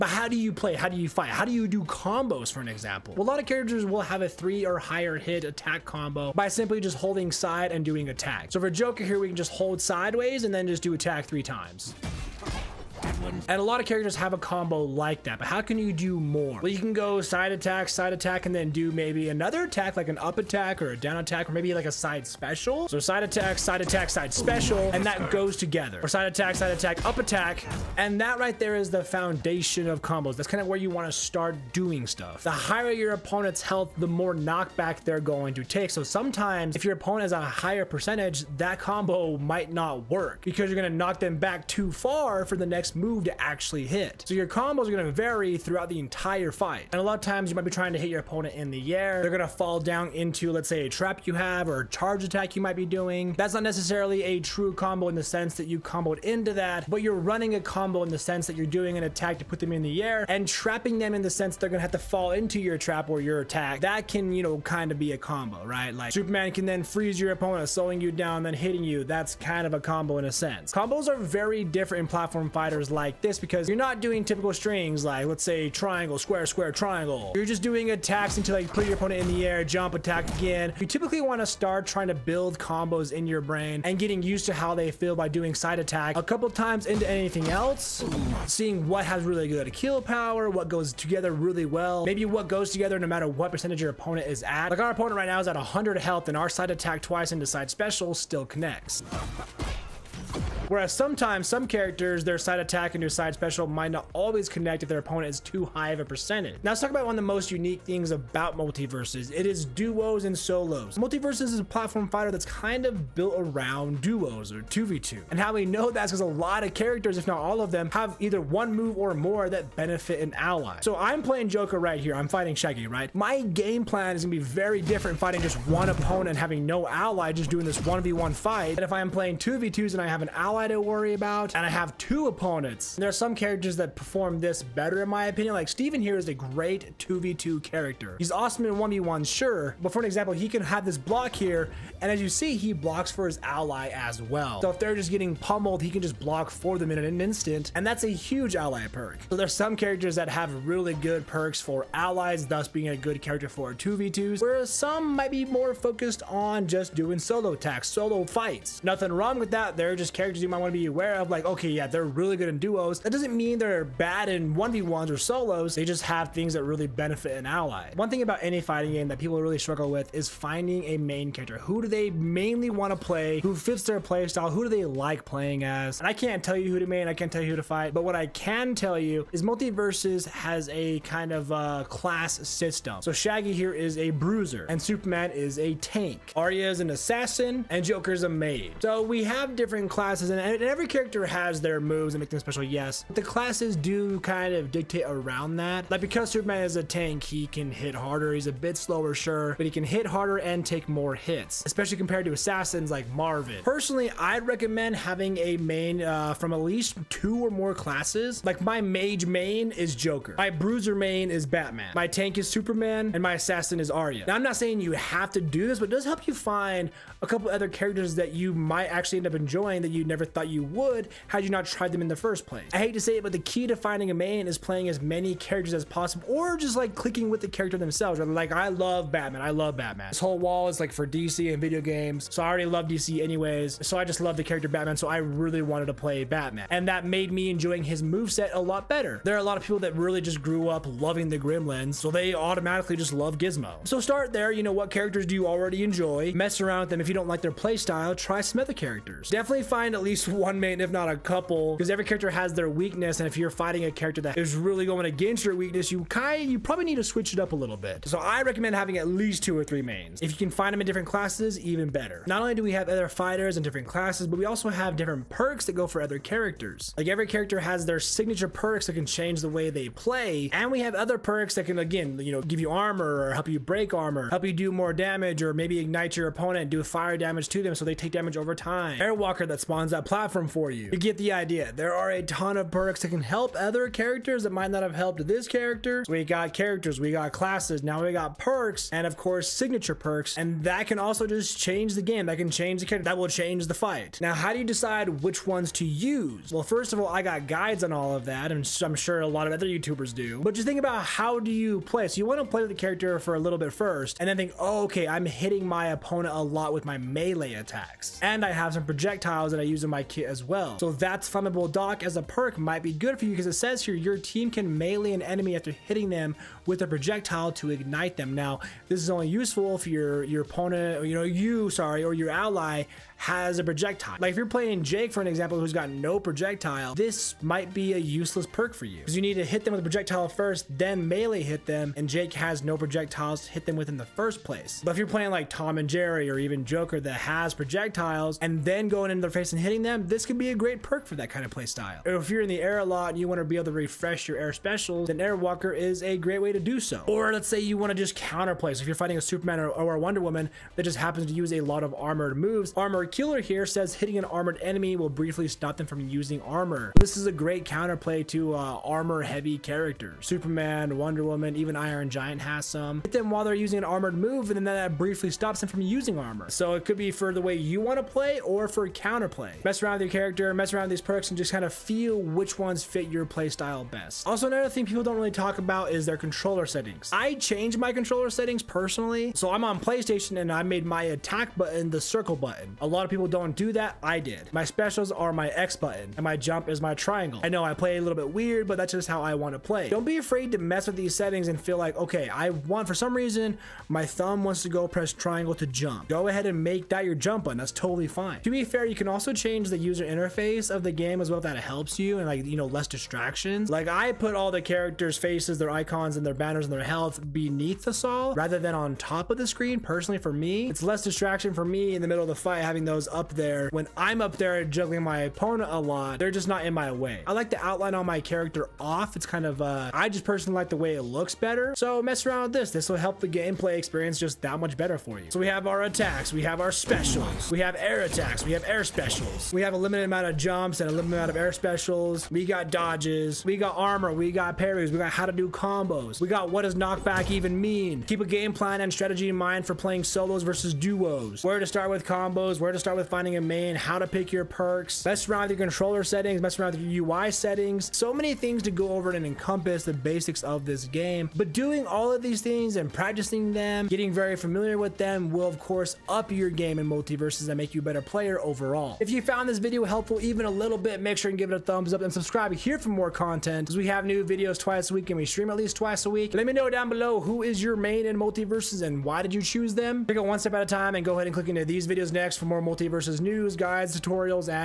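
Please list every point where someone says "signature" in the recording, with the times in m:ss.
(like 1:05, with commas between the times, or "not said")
4:27, 4:49.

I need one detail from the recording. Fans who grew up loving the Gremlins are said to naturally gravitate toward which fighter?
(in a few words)
Gizmo.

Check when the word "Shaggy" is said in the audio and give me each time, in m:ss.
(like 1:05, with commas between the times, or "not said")
2:02, 3:03.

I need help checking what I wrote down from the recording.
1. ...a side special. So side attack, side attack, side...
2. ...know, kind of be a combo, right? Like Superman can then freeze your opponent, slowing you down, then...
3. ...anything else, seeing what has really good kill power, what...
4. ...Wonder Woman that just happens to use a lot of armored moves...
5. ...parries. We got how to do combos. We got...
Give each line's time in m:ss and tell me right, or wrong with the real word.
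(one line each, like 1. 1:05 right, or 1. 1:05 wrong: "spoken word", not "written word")
1. 0:21 right
2. 1:04 right
3. 1:27 right
4. 5:49 right
5. 7:14 right.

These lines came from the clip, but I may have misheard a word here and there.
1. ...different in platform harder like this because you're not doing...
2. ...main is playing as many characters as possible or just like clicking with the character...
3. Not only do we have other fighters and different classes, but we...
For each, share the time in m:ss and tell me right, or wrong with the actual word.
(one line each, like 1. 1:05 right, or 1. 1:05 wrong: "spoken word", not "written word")
1. 1:11 wrong: "fighter", not "harder"
2. 3:44 right
3. 4:22 right.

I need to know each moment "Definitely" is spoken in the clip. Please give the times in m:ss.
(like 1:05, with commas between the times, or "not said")
4:09.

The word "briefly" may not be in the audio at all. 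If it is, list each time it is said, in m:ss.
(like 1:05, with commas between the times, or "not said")
5:55, 6:04.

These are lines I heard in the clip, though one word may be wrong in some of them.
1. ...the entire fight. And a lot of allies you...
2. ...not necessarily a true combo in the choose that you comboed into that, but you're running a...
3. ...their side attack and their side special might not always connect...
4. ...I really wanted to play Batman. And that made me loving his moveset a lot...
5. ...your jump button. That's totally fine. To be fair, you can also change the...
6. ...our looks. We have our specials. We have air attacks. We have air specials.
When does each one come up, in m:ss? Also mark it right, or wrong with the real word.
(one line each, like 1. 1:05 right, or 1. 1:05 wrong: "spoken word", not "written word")
1. 0:45 wrong: "times", not "allies"
2. 0:53 wrong: "sense", not "choose"
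3. 1:42 right
4. 3:55 wrong: "enjoying", not "loving"
5. 6:37 right
6. 7:05 wrong: "attacks", not "looks".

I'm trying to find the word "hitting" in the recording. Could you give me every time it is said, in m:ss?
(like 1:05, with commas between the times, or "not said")
1:08, 5:05, 5:15, 5:39, 5:53.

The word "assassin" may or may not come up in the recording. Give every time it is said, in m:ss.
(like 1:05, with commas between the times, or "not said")
3:06, 3:22, 3:33.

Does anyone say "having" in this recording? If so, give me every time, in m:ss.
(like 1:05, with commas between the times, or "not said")
2:06, 3:24, 4:18, 6:52.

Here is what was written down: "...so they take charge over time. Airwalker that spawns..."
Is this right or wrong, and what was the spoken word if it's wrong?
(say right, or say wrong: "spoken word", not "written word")
wrong: "damage", not "charge".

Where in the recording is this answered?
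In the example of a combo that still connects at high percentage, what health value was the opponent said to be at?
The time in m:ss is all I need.
1:35.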